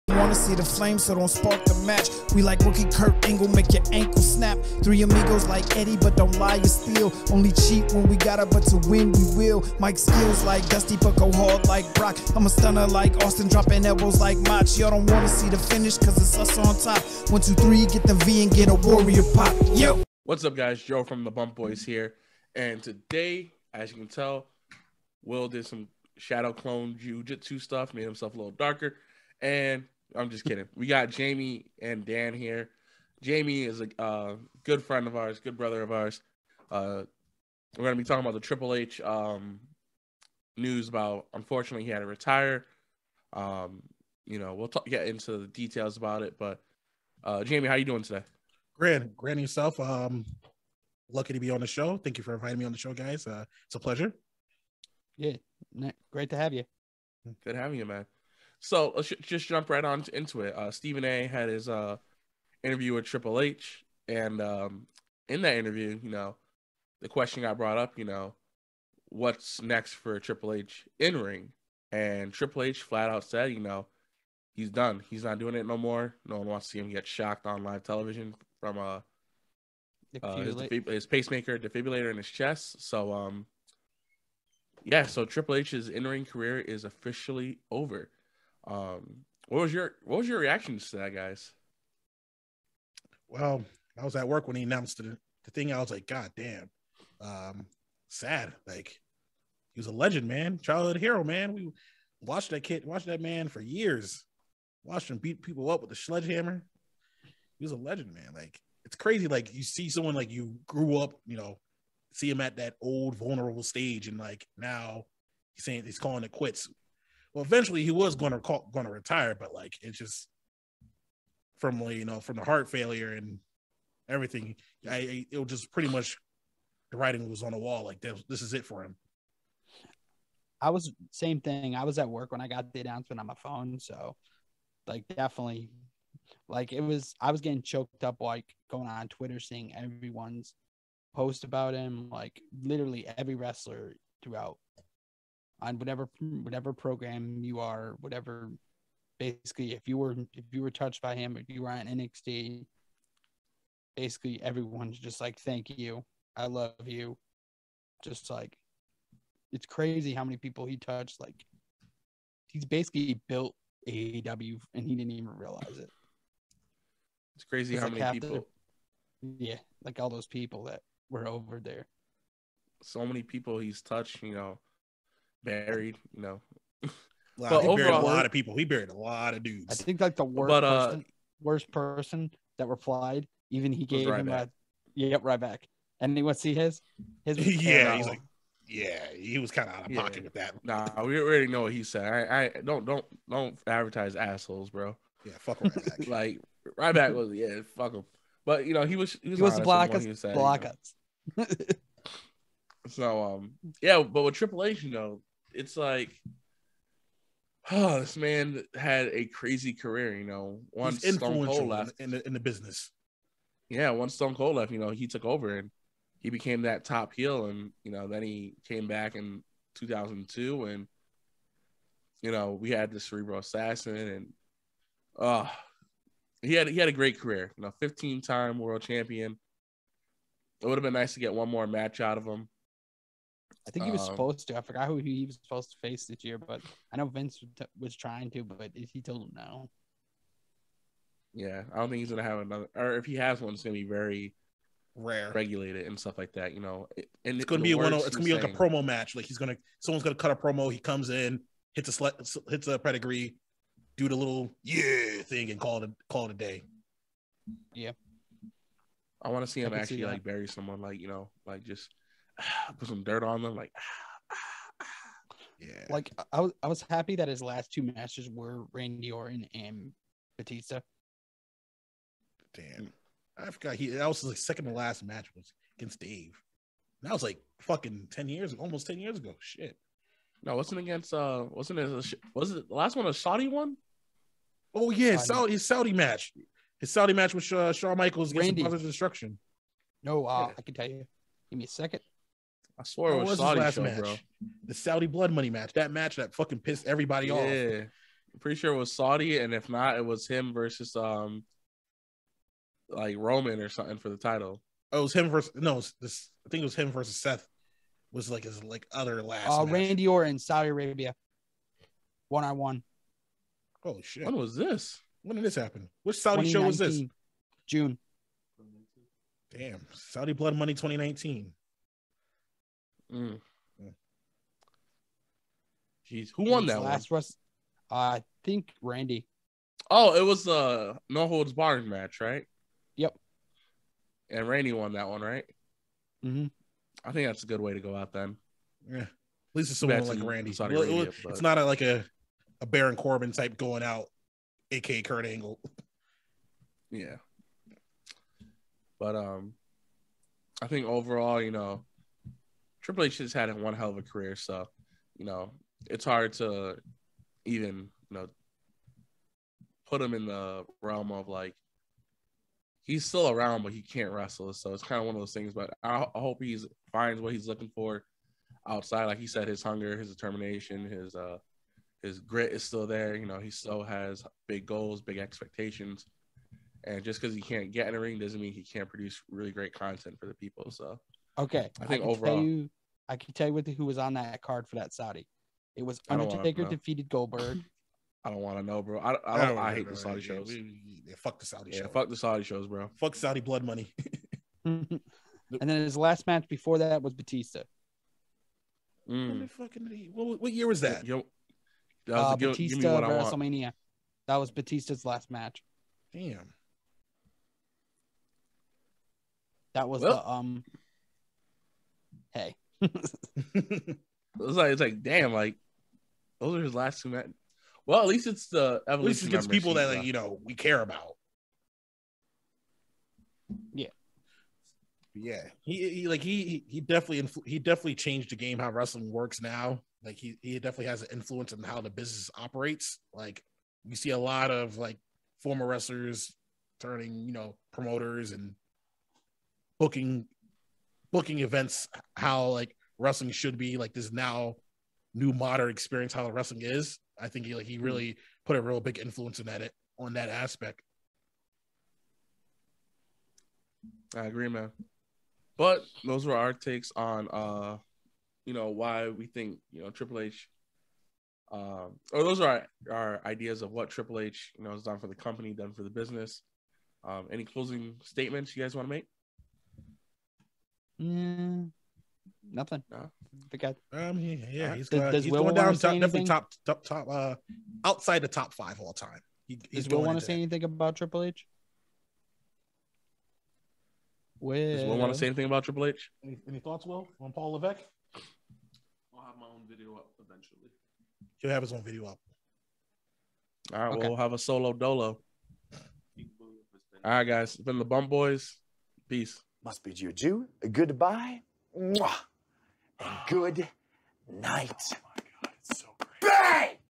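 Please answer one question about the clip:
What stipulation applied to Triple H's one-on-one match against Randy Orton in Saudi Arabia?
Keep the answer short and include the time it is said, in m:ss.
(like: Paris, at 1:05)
No holds barred, at 5:31.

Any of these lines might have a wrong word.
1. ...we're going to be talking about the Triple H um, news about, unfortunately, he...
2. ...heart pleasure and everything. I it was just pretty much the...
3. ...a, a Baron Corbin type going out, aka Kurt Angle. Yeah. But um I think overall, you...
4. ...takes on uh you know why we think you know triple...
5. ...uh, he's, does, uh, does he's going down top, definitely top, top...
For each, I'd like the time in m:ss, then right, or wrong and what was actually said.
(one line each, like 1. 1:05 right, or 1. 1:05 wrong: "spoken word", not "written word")
1. 0:37 right
2. 2:02 wrong: "failure", not "pleasure"
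3. 5:41 right
4. 7:36 right
5. 7:54 right.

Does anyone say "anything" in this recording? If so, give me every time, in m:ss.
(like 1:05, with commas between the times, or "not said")
8:00, 8:05.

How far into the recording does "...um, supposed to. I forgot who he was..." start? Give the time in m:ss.
3:54.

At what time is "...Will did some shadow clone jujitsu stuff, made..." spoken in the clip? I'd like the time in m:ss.
0:25.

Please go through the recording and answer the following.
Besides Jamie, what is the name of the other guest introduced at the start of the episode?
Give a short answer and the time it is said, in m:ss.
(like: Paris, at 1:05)
Dan, at 0:32.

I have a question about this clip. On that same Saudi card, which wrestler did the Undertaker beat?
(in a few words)
Goldberg.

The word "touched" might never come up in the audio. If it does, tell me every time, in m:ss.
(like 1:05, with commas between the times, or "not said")
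2:30, 2:40, 2:53.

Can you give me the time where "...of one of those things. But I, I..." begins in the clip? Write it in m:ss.
6:04.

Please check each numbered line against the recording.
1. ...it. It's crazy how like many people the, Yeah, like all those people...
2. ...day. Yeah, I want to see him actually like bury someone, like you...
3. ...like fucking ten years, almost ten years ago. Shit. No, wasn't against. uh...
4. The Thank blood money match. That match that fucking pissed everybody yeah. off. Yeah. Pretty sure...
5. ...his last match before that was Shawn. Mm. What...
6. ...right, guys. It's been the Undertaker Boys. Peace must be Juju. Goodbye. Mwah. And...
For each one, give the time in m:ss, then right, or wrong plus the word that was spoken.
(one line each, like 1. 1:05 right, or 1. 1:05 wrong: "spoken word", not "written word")
1. 2:45 right
2. 4:16 right
3. 4:37 right
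4. 4:54 wrong: "Saudi", not "Thank"
5. 6:35 wrong: "Batista", not "Shawn"
6. 8:17 wrong: "Bump", not "Undertaker".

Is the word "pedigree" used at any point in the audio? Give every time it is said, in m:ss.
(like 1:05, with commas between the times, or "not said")
4:12.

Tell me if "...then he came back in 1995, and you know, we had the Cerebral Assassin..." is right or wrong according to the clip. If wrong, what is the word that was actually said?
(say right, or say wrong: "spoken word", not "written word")
wrong: "2002", not "1995".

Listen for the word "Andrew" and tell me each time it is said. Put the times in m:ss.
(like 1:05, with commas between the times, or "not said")
not said.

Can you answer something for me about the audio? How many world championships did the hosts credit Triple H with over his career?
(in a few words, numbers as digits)
15.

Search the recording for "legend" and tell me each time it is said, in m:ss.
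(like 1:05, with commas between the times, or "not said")
1:39, 1:47.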